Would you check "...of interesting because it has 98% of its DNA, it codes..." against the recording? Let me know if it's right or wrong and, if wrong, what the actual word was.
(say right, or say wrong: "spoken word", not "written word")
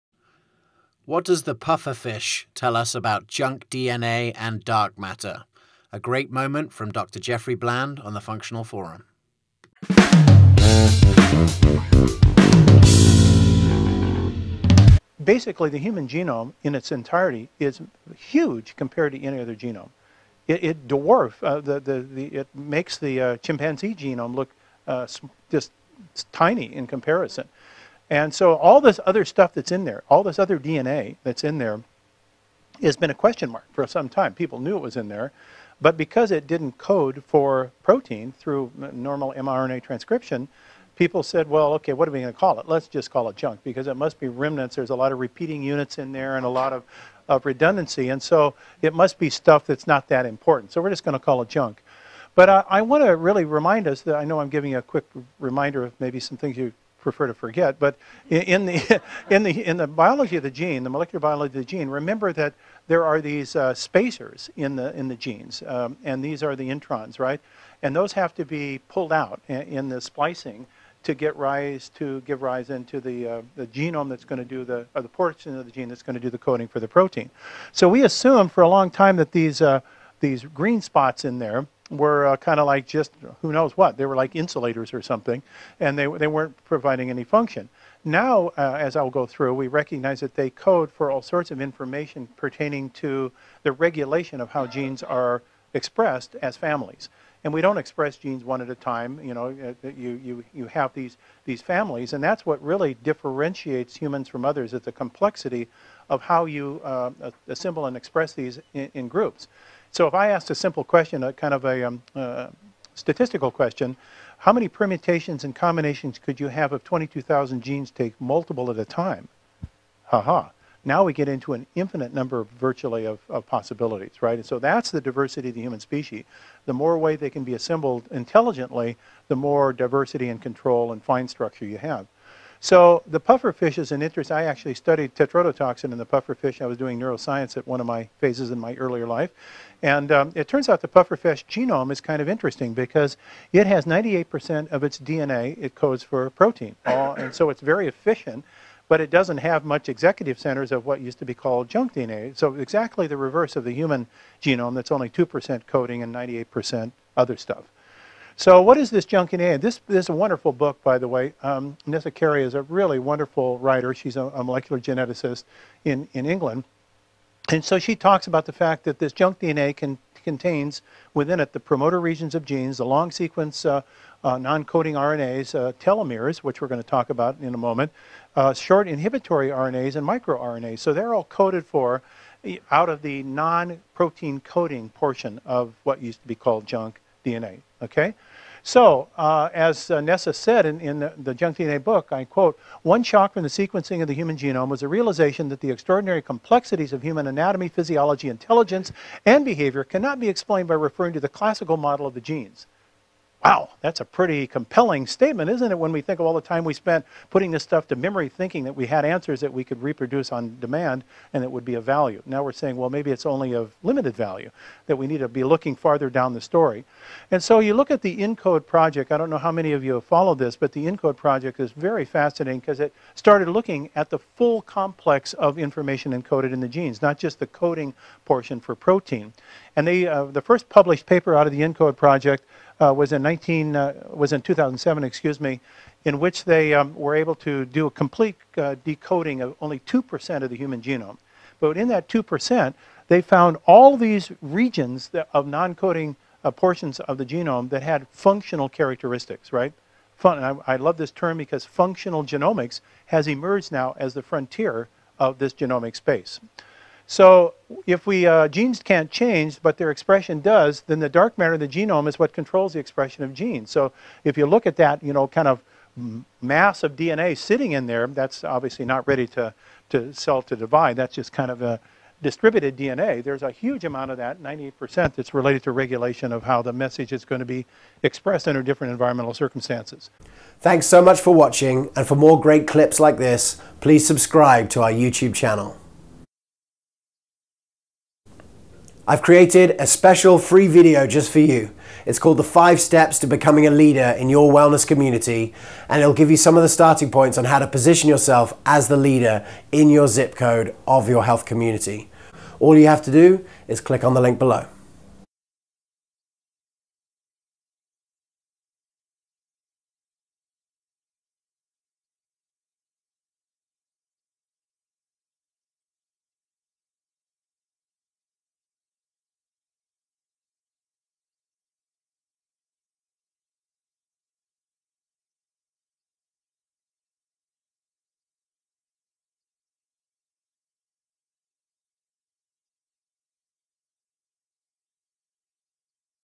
right.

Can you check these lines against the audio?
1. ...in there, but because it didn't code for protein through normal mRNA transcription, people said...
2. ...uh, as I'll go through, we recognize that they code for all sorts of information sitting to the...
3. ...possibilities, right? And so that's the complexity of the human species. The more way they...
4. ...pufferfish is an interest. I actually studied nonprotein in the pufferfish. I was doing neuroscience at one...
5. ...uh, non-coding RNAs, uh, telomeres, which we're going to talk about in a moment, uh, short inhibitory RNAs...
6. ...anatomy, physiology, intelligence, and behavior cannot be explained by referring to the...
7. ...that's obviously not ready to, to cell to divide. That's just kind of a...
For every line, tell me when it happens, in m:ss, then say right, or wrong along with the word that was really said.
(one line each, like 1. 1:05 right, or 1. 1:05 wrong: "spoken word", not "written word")
1. 0:34 right
2. 1:28 wrong: "pertaining", not "sitting"
3. 2:03 wrong: "diversity", not "complexity"
4. 2:13 wrong: "tetrodotoxin", not "nonprotein"
5. 2:54 right
6. 3:17 right
7. 4:28 right.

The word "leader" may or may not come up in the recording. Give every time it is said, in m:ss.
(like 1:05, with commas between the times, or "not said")
4:53, 4:58.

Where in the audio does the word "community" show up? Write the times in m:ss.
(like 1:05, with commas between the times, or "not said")
4:54, 5:01.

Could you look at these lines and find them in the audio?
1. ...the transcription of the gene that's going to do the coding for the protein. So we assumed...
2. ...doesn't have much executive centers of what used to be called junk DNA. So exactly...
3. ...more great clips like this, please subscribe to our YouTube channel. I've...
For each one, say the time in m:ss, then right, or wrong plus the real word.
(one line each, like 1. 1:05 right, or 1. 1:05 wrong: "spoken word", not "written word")
1. 1:15 wrong: "portion", not "transcription"
2. 2:29 right
3. 4:42 right.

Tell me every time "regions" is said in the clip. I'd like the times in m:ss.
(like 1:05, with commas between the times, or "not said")
2:51, 4:04.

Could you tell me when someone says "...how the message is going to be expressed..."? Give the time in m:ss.
4:36.